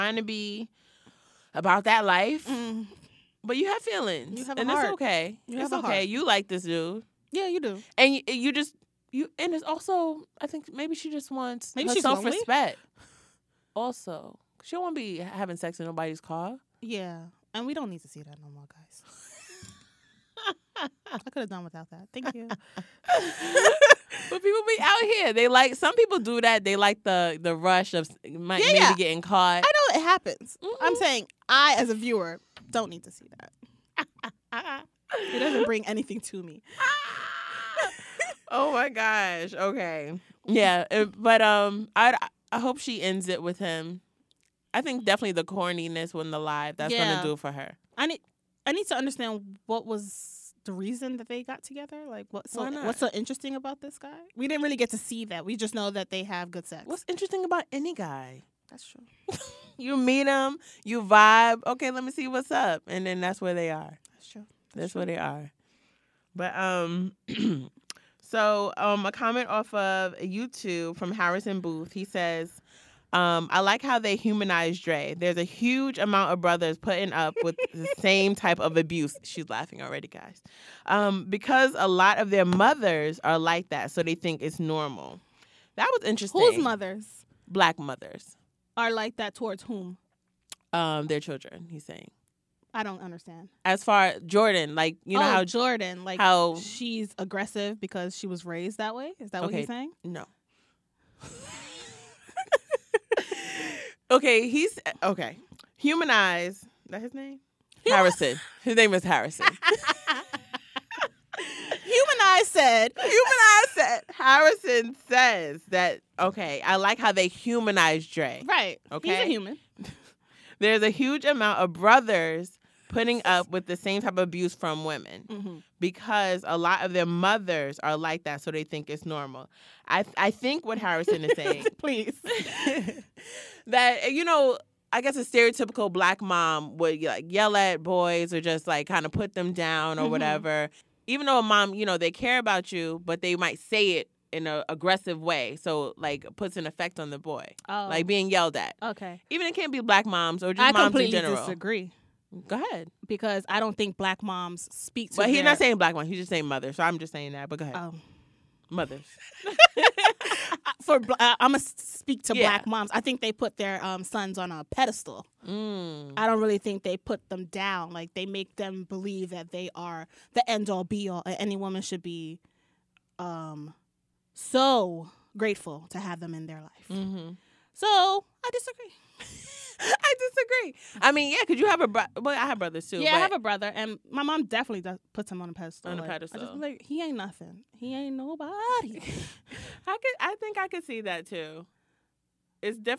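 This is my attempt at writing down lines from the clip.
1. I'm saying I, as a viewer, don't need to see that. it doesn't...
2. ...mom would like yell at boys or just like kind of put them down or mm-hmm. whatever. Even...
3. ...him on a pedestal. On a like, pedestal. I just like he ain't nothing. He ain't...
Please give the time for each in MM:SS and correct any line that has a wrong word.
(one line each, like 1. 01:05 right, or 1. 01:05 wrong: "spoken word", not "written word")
1. 00:30 right
2. 02:16 right
3. 03:05 right.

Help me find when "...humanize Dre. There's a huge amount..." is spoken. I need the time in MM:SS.
01:14.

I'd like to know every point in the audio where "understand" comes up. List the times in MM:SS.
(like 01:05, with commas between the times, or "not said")
00:48, 01:33.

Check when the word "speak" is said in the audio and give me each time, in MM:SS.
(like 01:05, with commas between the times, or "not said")
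02:34, 02:41.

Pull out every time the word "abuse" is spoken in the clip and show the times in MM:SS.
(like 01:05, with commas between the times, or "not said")
01:18, 02:04.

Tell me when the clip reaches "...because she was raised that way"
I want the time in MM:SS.
01:37.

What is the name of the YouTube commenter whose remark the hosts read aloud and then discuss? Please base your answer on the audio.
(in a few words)
Harrison Booth.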